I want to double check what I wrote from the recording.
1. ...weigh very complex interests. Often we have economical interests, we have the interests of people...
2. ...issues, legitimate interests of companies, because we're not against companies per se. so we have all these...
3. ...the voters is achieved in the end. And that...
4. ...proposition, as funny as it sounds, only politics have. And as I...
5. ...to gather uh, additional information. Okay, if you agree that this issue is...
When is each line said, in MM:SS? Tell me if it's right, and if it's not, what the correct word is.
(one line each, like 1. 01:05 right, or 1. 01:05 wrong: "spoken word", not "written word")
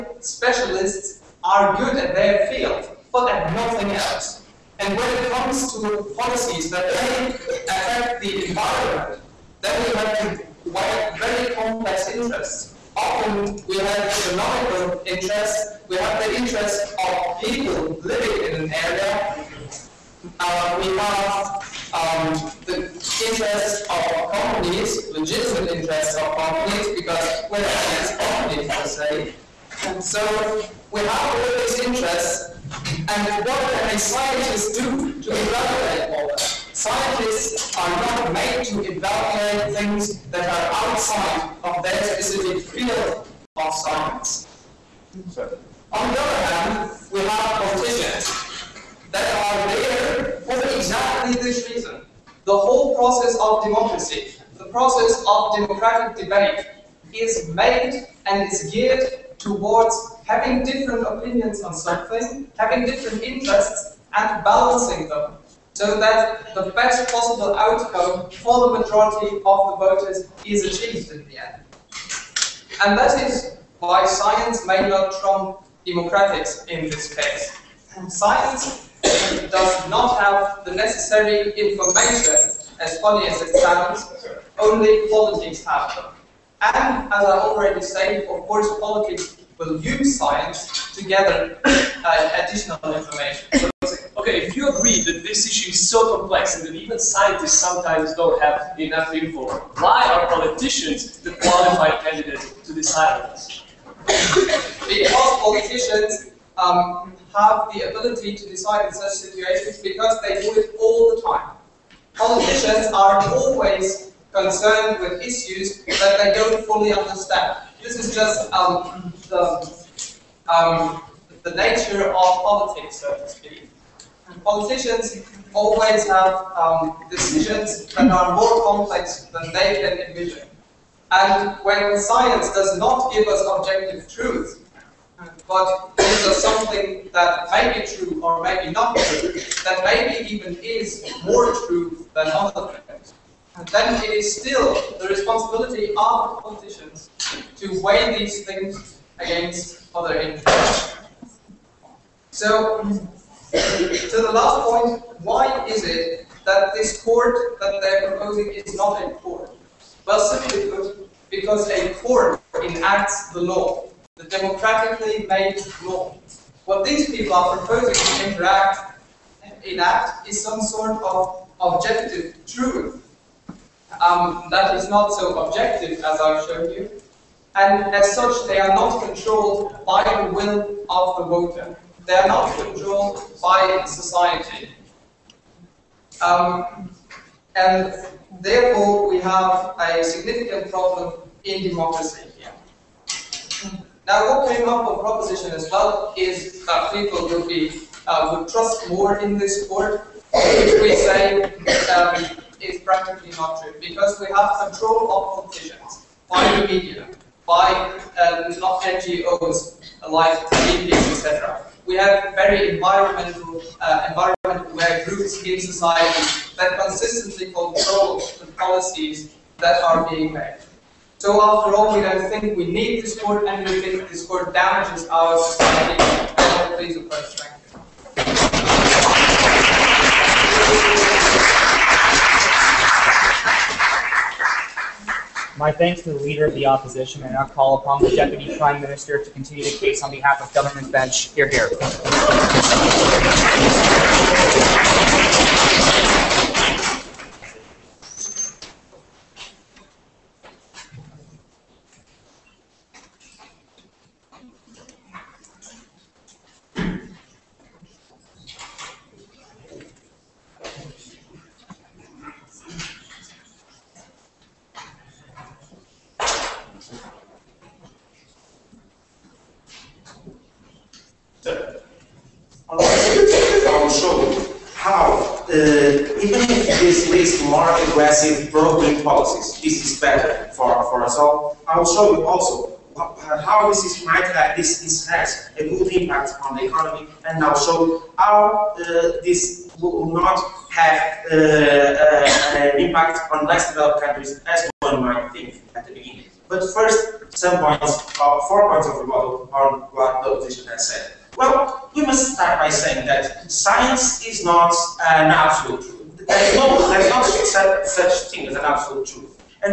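1. 00:10 right
2. 00:24 wrong: "companies", not "issues"
3. 01:09 right
4. 01:21 wrong: "information", not "proposition"
5. 01:30 right.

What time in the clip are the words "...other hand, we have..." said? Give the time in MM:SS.
00:46.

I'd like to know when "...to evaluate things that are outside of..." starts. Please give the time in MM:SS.
00:38.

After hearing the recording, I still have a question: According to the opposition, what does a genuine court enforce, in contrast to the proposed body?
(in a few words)
democratically made law.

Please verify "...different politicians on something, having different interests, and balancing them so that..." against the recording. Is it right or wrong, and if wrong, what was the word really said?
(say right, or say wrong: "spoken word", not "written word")
wrong: "opinions", not "politicians".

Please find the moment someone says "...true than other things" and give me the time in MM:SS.
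02:21.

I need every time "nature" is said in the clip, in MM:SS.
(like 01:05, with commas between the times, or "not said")
02:01.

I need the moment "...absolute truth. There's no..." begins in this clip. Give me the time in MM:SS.
05:05.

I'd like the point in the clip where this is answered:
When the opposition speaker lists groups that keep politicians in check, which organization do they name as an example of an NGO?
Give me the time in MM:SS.
03:30.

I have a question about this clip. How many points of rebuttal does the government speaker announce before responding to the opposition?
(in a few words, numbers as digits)
4.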